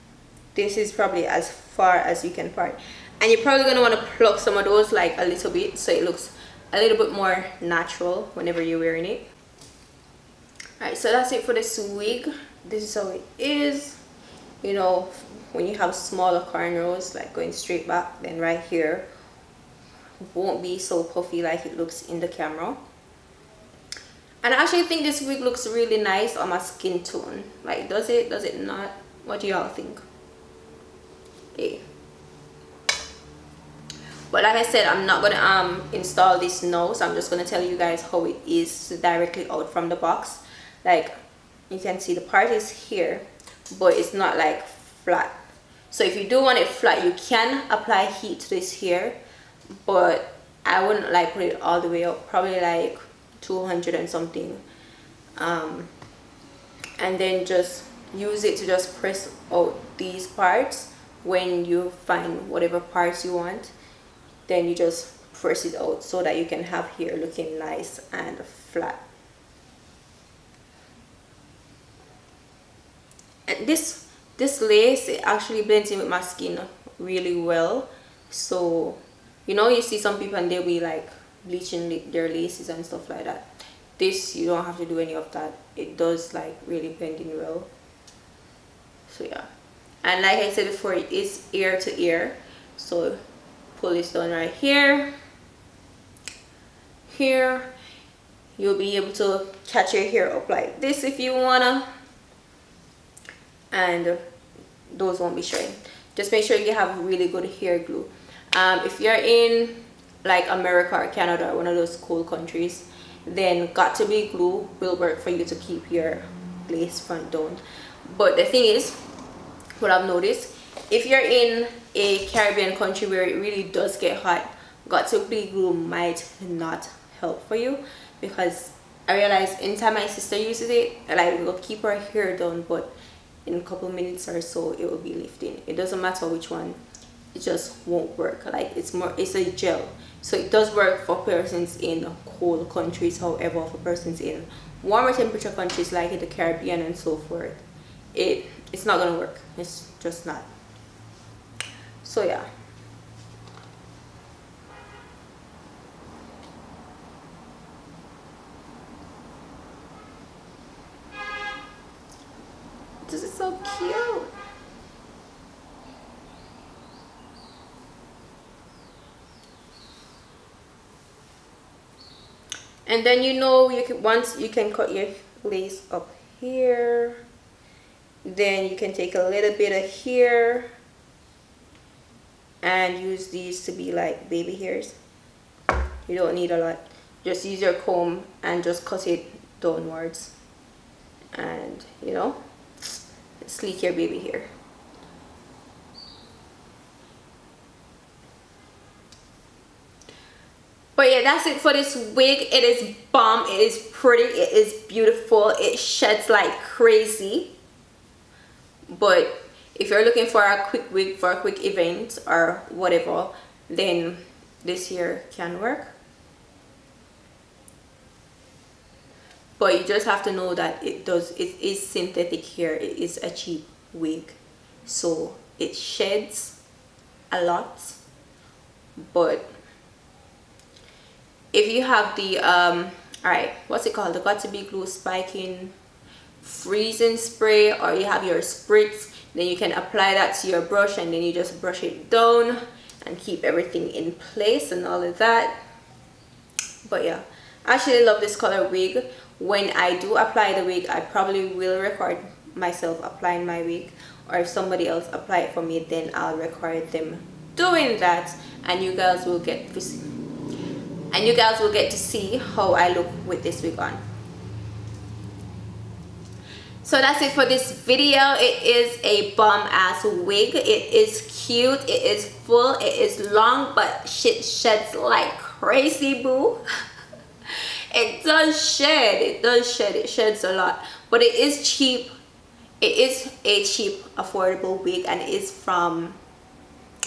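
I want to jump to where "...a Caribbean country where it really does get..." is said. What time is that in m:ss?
2:01.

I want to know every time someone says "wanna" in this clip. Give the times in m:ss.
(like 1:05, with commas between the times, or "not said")
0:03, 1:41.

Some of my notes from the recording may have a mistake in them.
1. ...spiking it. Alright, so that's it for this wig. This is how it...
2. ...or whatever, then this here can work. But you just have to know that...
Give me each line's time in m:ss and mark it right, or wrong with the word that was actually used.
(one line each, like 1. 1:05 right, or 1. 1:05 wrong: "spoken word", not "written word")
1. 0:08 wrong: "wearing", not "spiking"
2. 3:32 right.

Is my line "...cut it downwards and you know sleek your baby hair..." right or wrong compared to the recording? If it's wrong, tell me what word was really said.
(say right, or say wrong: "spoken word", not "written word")
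right.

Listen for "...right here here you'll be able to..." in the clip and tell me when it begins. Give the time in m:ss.
1:34.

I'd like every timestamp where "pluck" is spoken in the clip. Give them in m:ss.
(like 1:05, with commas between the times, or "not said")
0:04.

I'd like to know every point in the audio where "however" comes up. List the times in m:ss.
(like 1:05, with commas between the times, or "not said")
2:23.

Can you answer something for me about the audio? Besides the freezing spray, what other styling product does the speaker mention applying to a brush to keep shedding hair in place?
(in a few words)
spritz.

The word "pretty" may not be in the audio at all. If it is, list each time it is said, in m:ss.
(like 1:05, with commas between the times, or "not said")
3:23.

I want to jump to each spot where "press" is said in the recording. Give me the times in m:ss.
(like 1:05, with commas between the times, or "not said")
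0:58, 1:05.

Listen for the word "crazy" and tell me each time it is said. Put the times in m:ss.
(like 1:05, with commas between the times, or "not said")
3:26, 4:35.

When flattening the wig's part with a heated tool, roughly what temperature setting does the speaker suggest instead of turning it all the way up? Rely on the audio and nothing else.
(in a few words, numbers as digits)
200 and something.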